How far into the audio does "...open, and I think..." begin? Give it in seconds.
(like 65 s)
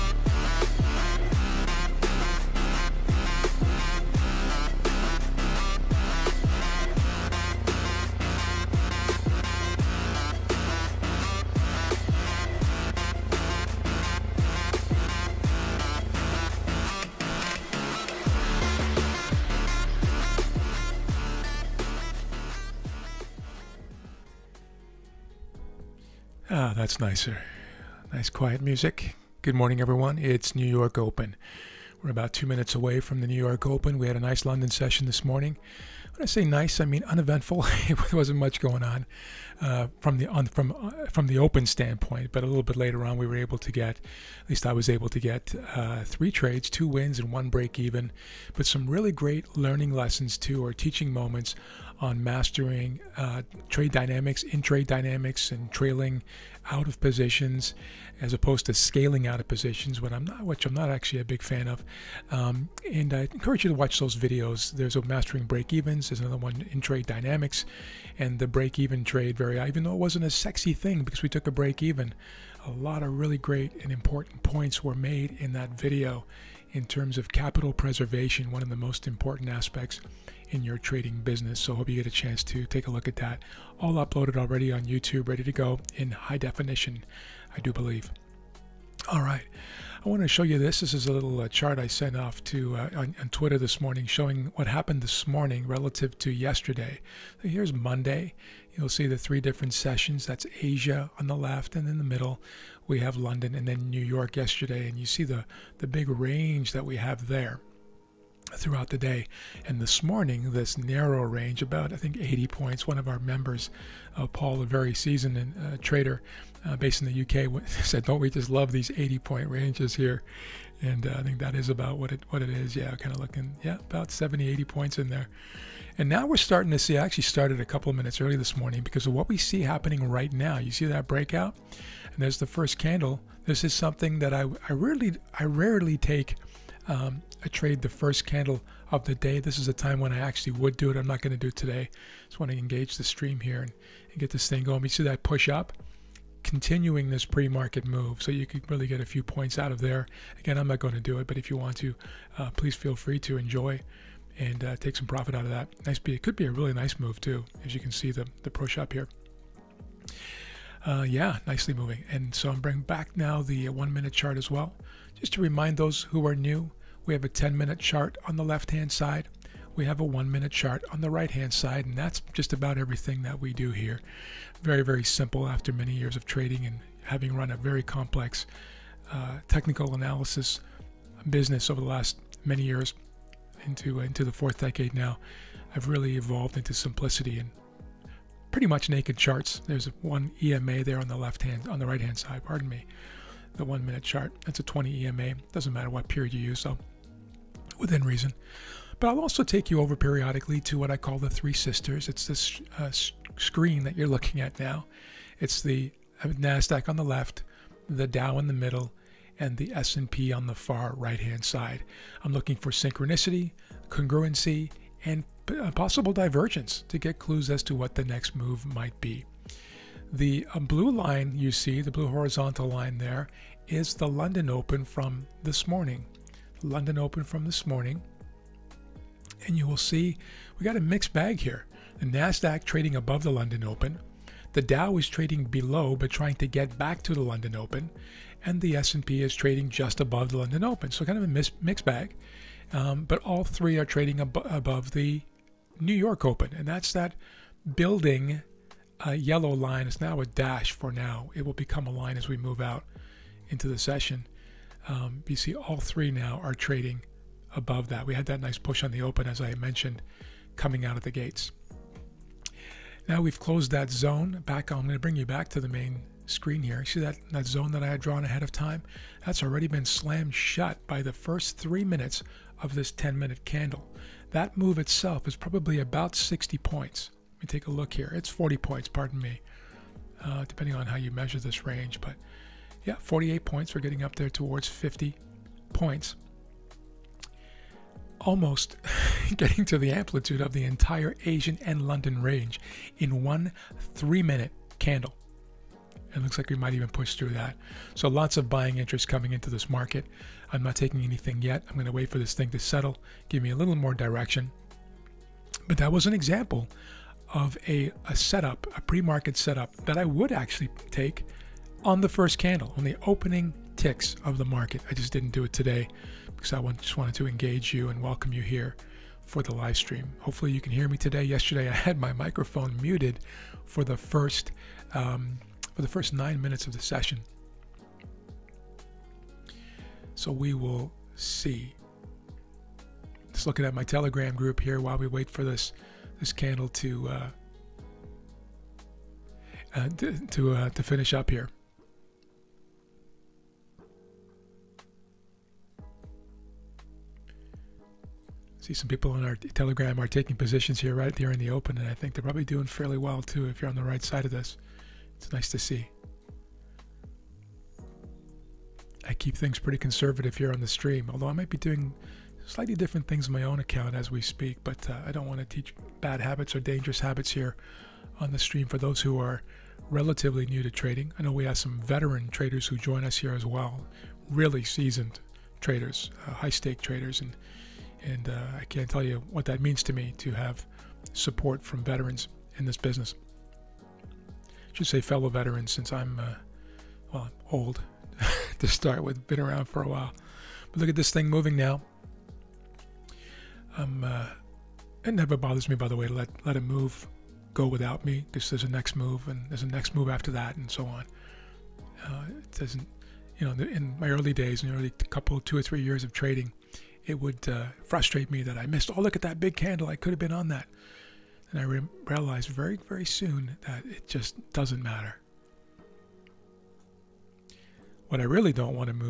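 351 s.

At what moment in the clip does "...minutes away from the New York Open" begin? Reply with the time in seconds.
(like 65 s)
32 s.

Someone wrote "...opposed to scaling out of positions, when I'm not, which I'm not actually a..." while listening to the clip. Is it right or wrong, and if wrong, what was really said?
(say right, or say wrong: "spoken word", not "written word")
right.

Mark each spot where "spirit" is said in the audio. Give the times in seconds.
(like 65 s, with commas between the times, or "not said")
not said.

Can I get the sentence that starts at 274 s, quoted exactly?
That move itself is probably about 60 points.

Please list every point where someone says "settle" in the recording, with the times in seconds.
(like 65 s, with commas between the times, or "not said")
302 s.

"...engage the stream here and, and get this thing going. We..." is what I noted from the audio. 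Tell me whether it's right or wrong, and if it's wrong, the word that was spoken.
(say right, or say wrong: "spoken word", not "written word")
right.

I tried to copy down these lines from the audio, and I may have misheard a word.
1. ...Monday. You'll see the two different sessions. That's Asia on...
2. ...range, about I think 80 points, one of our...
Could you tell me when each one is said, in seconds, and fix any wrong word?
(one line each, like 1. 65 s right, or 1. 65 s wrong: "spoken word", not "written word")
1. 97 s wrong: "three", not "two"
2. 111 s right.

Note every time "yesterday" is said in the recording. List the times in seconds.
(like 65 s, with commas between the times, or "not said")
96 s, 104 s, 321 s.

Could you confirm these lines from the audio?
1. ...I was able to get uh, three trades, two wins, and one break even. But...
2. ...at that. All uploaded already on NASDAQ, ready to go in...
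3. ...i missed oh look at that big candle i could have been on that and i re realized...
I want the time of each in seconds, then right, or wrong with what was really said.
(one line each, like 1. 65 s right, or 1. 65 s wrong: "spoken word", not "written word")
1. 44 s right
2. 83 s wrong: "YouTube", not "NASDAQ"
3. 408 s right.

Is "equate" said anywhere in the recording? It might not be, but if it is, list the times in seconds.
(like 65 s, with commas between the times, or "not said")
not said.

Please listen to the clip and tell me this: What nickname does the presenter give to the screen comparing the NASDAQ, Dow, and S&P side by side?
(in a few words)
Three Sisters.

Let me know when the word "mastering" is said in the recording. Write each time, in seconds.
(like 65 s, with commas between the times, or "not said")
52 s, 65 s.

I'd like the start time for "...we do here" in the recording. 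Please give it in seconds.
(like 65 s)
173 s.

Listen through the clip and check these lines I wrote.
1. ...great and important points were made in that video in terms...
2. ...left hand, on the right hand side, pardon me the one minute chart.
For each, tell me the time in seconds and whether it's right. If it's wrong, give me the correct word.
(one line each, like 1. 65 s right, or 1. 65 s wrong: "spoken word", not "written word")
1. 73 s right
2. 191 s right.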